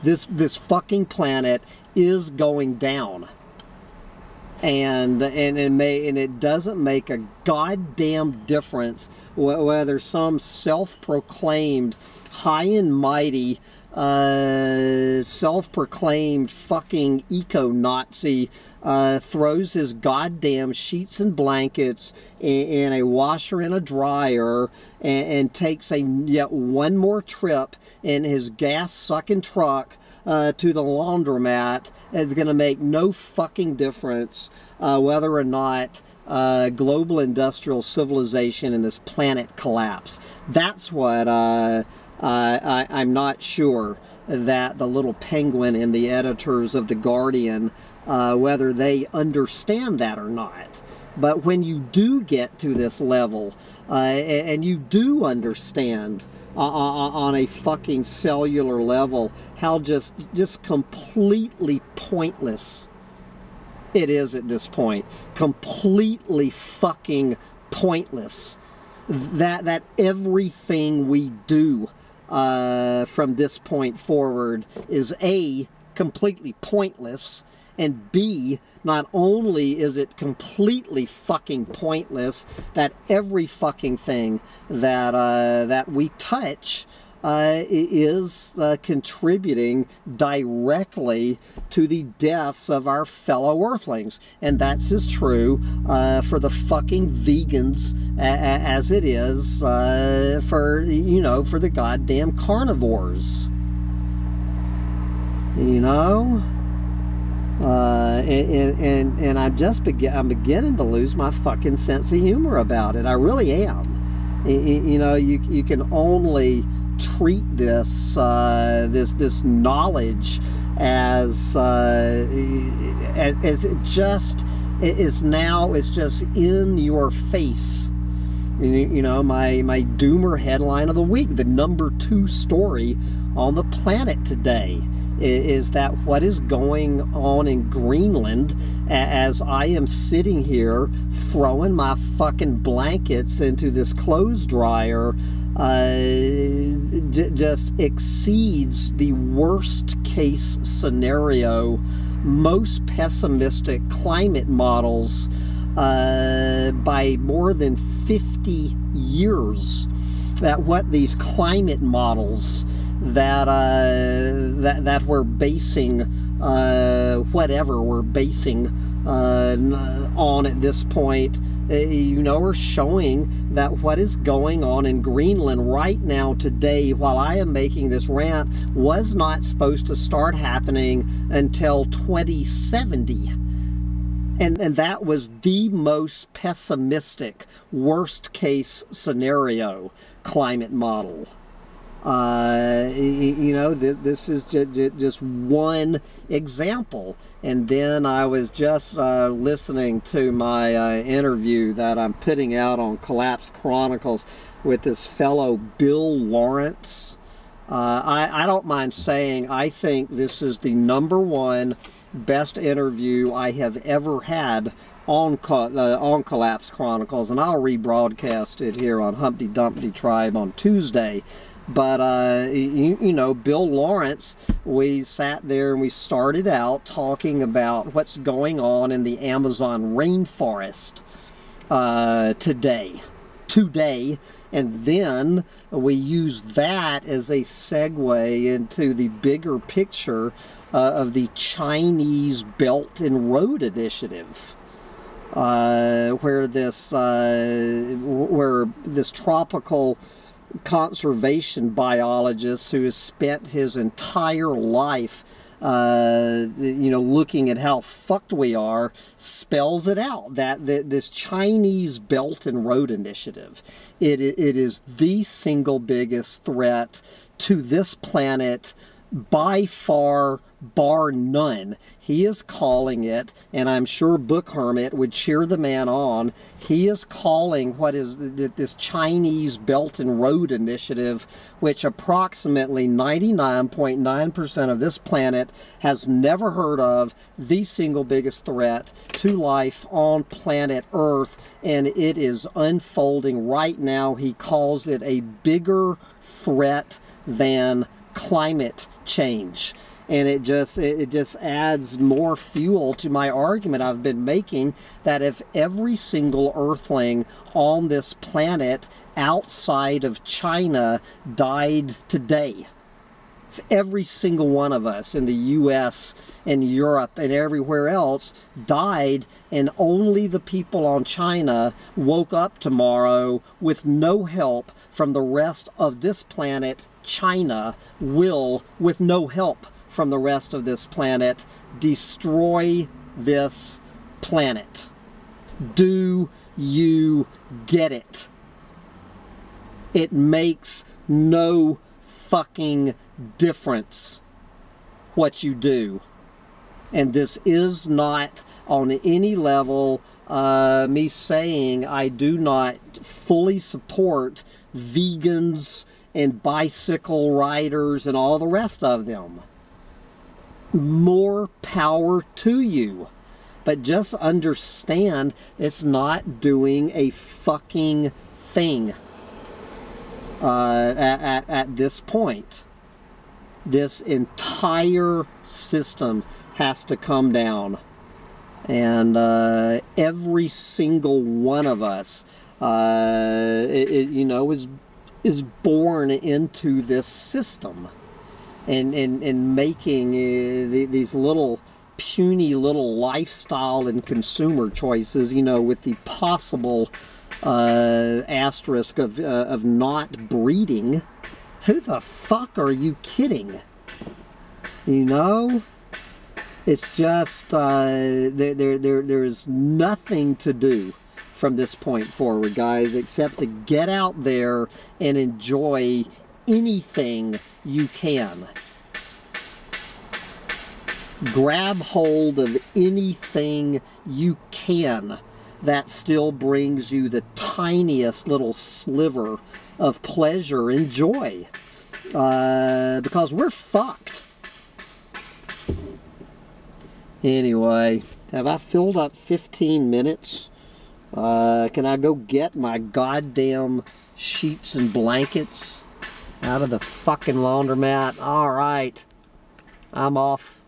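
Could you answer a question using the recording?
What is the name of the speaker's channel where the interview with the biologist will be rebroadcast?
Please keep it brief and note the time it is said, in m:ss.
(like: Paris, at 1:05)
Humpty Dumpty Tribe, at 3:39.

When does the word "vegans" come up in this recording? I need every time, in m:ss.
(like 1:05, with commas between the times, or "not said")
1:37, 5:54.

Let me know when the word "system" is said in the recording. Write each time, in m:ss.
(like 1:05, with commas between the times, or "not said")
6:15, 6:27.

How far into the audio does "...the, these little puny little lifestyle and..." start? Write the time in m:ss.
6:30.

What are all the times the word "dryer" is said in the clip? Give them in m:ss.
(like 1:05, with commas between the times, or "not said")
0:23, 2:24.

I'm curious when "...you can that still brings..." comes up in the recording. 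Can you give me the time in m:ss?
7:04.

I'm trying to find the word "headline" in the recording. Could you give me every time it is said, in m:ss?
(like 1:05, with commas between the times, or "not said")
2:10.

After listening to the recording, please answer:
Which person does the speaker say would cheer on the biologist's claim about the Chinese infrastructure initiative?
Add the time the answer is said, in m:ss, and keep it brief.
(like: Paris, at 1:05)
Book Hermit, at 4:34.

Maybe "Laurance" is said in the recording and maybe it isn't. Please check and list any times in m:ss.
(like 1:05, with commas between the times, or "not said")
3:26, 3:43.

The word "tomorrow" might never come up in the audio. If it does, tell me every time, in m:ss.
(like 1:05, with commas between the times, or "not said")
5:22.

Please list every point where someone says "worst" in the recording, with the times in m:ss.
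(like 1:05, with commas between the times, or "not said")
2:29, 3:07.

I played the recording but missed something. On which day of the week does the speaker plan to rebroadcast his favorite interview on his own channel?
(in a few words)
Tuesday.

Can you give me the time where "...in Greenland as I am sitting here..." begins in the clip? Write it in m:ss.
2:17.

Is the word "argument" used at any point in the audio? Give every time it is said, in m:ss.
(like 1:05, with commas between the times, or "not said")
5:03.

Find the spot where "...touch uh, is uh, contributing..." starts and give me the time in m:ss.
1:26.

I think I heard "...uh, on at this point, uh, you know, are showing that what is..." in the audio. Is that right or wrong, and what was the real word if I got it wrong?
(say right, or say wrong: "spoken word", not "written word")
right.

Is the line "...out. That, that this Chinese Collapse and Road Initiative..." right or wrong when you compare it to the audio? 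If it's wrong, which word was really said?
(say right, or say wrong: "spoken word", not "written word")
wrong: "Belt", not "Collapse".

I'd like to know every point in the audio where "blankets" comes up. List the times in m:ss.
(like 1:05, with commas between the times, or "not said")
0:21, 2:22, 7:24.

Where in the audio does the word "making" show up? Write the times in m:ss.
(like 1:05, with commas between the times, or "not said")
2:57, 5:04, 6:29.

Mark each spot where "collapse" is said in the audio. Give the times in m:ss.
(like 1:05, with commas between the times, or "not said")
0:39, 3:22, 3:36.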